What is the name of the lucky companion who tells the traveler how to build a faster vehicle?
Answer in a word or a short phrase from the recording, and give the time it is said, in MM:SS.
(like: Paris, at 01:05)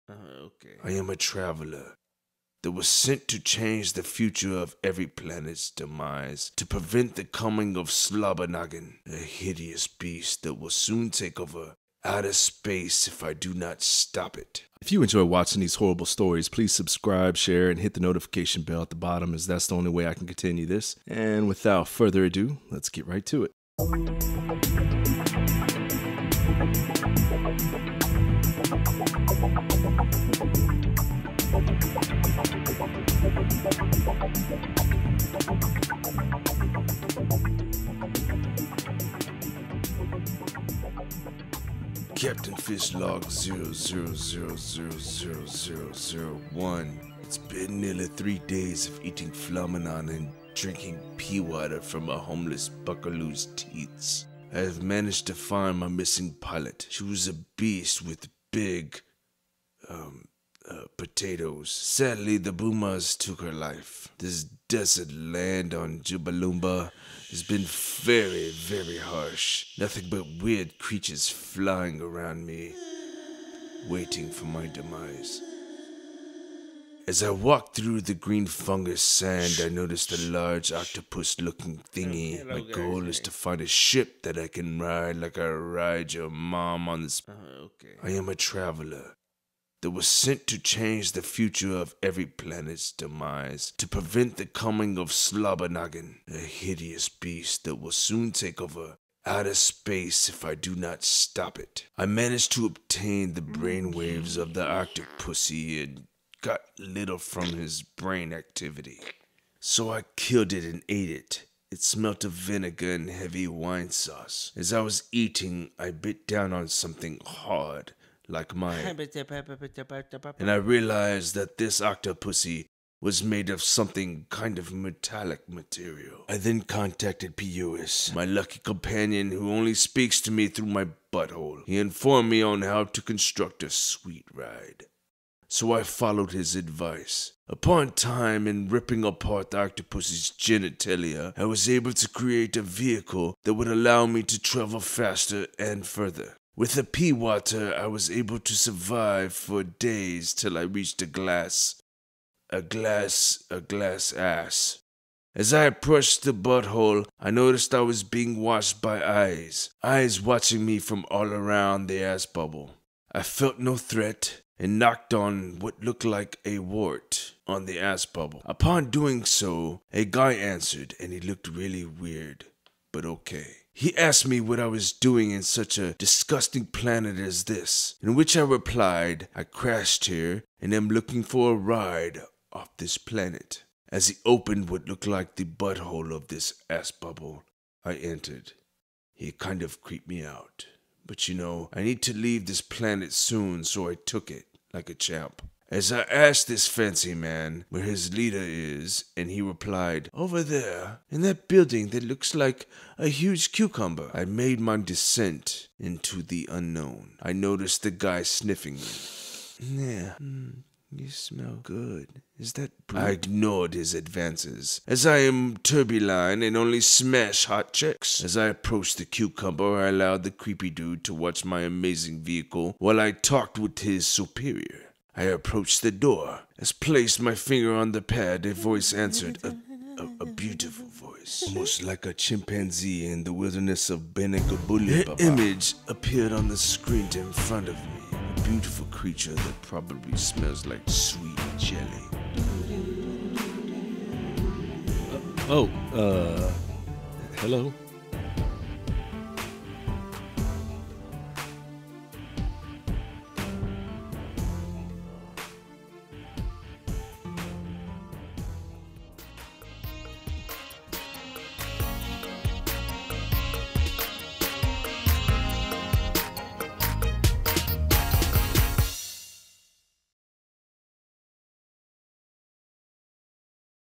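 Pius, at 02:07.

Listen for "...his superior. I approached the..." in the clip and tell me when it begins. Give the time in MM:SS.
03:43.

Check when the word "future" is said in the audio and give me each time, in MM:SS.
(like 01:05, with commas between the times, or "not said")
00:04, 01:31.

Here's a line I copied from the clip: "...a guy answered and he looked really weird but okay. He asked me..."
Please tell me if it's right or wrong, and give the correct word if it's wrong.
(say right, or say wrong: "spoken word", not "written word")
right.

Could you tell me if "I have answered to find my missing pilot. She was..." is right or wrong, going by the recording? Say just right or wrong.
wrong.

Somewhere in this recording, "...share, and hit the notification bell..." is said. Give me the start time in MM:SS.
00:17.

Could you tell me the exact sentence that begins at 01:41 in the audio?
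I managed to obtain the brainwaves of the Pussy and got little from his brain activity.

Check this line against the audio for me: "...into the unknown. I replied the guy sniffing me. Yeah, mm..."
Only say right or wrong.
wrong.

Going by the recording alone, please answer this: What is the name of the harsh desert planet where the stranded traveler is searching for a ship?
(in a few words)
Jubalumba.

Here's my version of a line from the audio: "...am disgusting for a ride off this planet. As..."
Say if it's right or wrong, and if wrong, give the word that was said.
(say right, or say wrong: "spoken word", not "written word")
wrong: "looking", not "disgusting".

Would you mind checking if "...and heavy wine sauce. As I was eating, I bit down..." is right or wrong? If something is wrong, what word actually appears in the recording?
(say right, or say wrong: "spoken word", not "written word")
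right.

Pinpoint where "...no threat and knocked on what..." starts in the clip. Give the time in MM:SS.
02:43.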